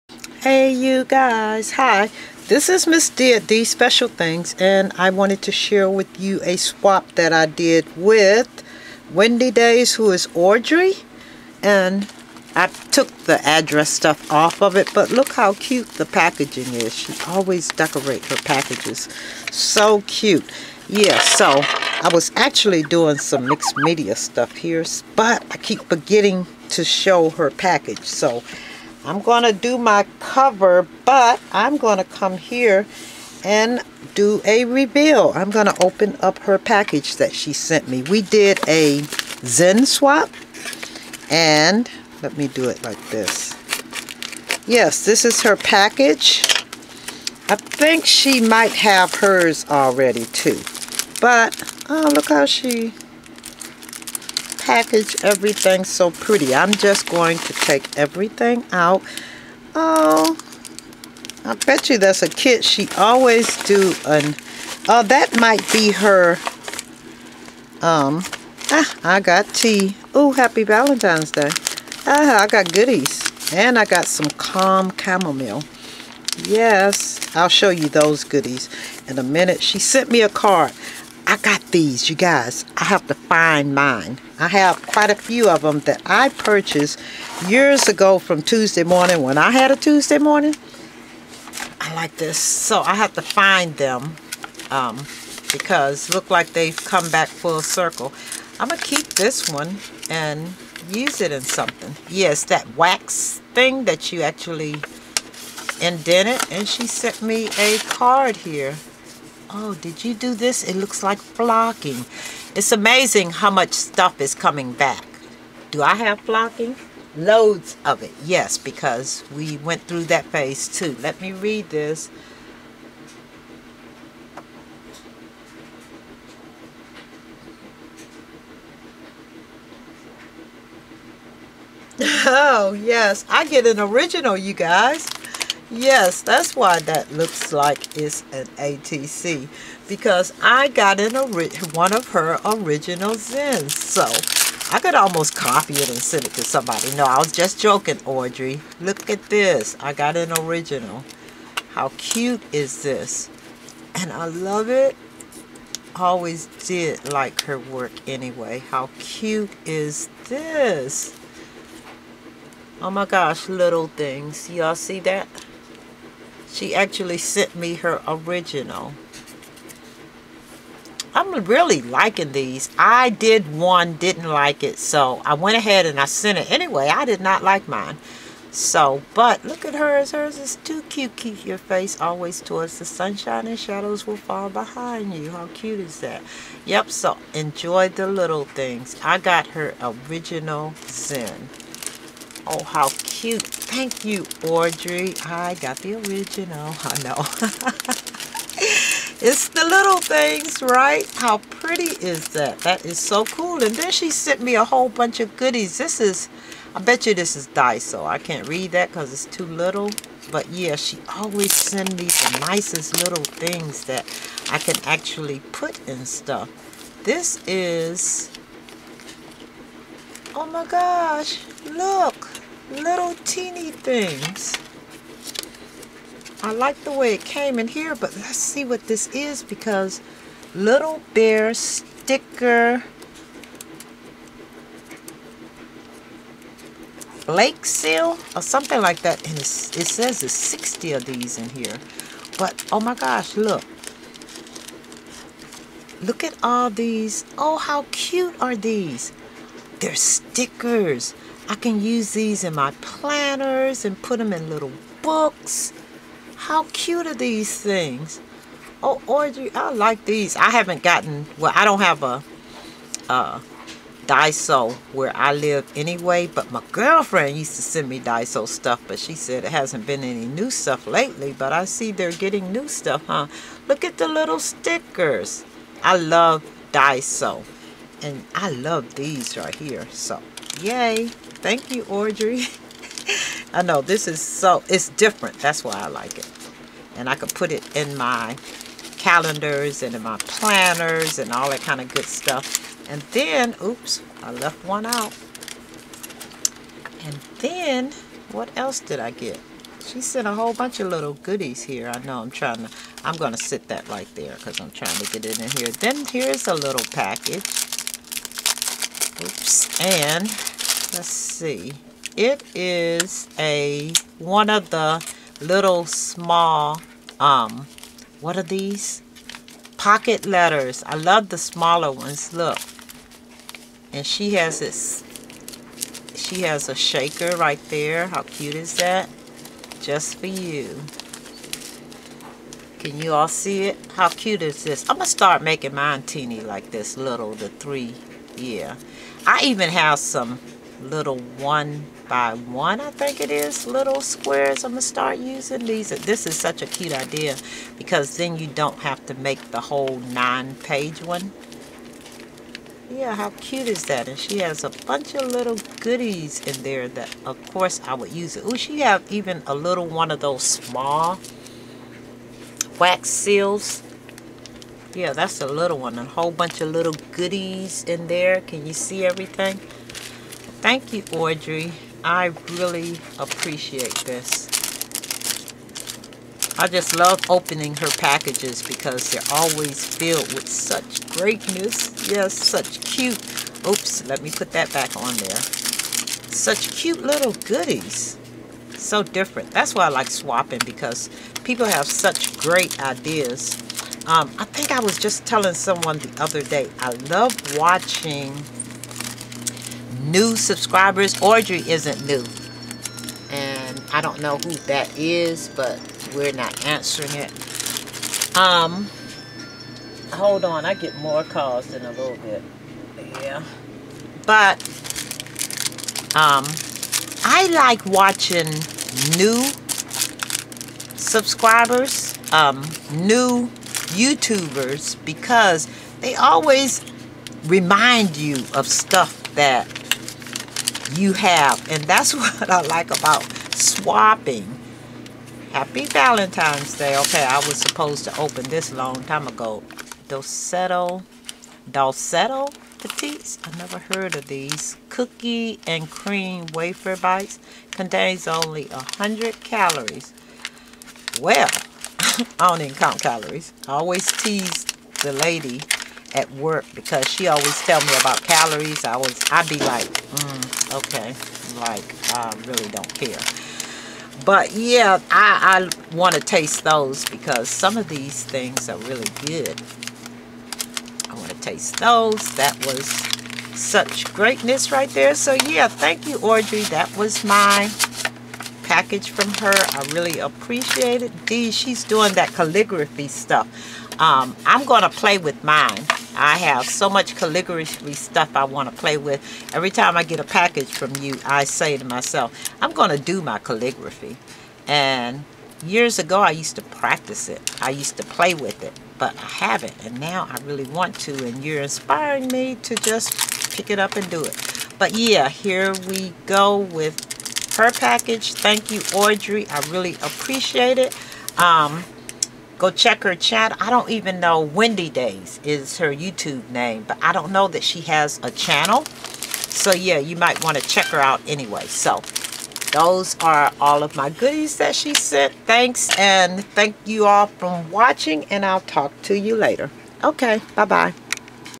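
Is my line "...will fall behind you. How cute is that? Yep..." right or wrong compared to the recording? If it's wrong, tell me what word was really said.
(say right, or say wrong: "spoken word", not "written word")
right.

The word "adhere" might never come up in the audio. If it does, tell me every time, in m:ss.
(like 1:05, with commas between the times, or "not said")
not said.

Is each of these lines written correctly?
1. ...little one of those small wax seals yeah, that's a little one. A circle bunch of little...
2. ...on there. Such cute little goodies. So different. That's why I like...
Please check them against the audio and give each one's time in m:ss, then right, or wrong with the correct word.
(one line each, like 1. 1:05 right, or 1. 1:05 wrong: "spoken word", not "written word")
1. 5:59 wrong: "whole", not "circle"
2. 6:24 right.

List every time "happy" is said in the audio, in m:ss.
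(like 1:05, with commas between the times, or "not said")
1:10, 7:15.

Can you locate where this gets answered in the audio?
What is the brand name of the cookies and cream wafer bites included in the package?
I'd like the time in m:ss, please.
7:21.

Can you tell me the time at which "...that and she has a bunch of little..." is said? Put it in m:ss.
5:53.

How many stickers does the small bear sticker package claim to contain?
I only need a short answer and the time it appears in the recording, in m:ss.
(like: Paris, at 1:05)
60, at 4:00.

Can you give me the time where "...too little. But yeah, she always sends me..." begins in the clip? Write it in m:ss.
3:29.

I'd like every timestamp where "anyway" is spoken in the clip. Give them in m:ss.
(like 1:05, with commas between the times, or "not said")
2:38, 2:56, 4:25, 8:41.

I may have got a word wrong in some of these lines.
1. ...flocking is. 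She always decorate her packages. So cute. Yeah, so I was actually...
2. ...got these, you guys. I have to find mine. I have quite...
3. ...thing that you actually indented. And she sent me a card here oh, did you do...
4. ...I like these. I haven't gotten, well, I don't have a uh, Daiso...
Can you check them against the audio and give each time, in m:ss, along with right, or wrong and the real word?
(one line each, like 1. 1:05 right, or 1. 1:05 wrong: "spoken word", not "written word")
1. 0:16 wrong: "packaging", not "flocking"
2. 1:21 right
3. 1:43 right
4. 4:19 right.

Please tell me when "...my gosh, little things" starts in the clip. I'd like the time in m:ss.
2:42.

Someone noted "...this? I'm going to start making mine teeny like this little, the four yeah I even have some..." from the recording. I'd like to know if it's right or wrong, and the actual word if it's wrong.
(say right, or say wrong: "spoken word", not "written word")
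wrong: "three", not "four".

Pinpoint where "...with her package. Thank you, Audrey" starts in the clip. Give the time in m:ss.
8:26.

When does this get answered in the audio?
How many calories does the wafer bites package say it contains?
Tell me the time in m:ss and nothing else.
7:28.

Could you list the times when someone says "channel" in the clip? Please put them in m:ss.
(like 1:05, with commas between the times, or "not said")
8:33, 8:38.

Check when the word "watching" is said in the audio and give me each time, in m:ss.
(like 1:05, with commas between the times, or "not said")
6:37, 6:57, 8:47.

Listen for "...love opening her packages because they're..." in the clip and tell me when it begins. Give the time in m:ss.
6:16.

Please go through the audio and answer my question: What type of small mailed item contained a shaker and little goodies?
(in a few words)
Pocket letters.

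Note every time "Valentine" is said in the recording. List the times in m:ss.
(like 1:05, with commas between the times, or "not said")
1:10, 7:15.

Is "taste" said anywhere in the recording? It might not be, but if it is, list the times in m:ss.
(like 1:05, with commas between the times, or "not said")
7:46, 7:51.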